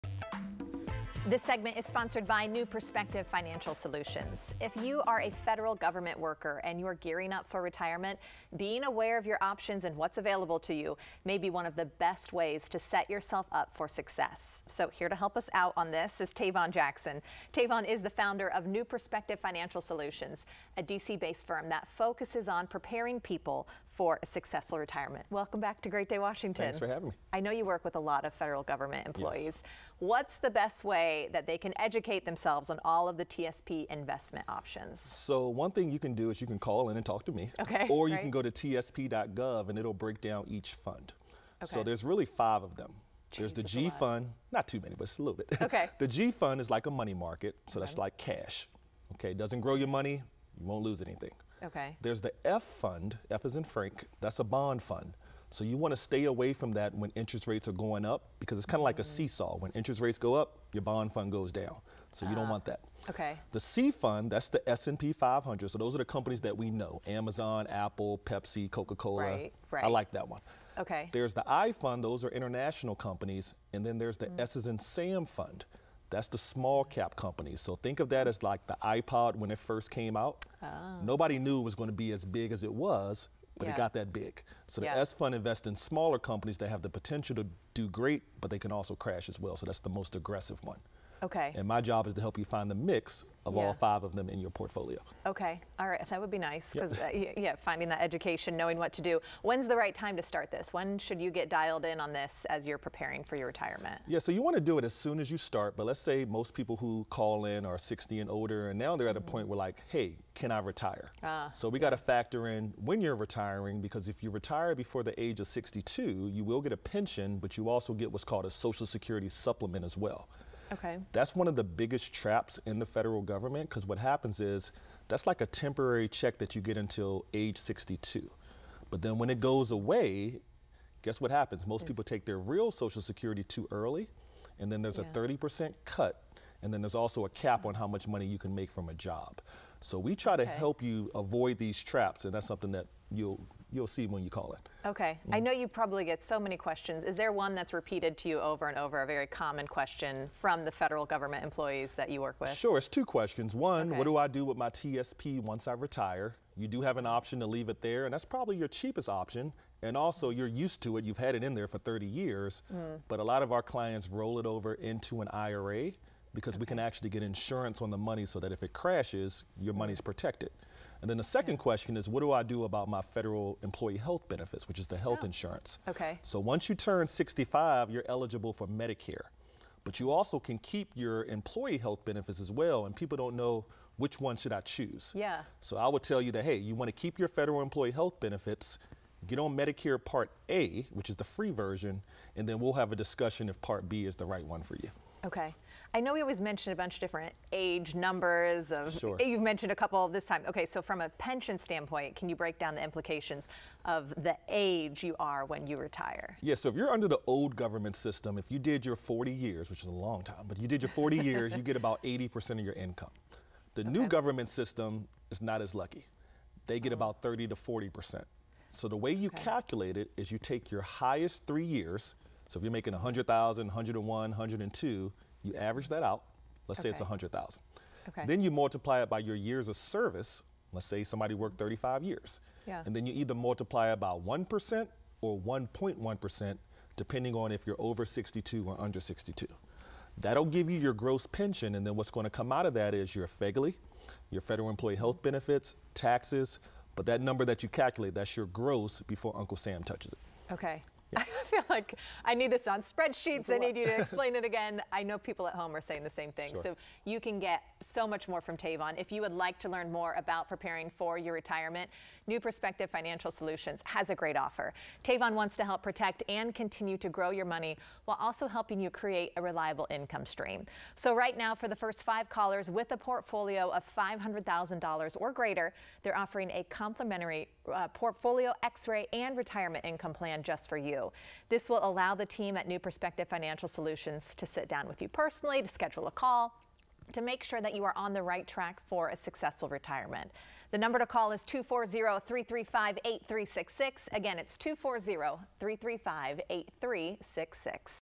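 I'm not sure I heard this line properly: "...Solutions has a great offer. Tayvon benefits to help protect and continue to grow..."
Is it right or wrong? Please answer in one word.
wrong.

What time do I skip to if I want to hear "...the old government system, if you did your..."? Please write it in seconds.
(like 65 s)
207 s.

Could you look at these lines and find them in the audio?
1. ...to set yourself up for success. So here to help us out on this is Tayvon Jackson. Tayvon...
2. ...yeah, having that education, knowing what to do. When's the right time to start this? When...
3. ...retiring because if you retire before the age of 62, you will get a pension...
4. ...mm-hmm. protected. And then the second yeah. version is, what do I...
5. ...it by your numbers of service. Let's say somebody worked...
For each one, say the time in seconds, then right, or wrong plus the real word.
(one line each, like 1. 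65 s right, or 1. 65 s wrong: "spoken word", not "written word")
1. 12 s right
2. 97 s wrong: "finding", not "having"
3. 113 s right
4. 169 s wrong: "question", not "version"
5. 229 s wrong: "years", not "numbers".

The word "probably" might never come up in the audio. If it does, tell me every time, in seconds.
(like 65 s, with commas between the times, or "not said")
145 s, 158 s.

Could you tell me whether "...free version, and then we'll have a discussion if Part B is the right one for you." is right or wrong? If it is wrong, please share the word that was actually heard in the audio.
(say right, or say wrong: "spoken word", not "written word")
right.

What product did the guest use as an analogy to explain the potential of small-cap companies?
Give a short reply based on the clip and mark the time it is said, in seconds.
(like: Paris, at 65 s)
iPod, at 78 s.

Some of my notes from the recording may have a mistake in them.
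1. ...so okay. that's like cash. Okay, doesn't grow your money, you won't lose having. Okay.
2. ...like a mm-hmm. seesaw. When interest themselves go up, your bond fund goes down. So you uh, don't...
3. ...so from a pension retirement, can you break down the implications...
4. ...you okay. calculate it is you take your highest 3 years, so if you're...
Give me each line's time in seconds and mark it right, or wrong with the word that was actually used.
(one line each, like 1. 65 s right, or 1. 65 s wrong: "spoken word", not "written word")
1. 47 s wrong: "anything", not "having"
2. 58 s wrong: "rates", not "themselves"
3. 200 s wrong: "standpoint", not "retirement"
4. 219 s right.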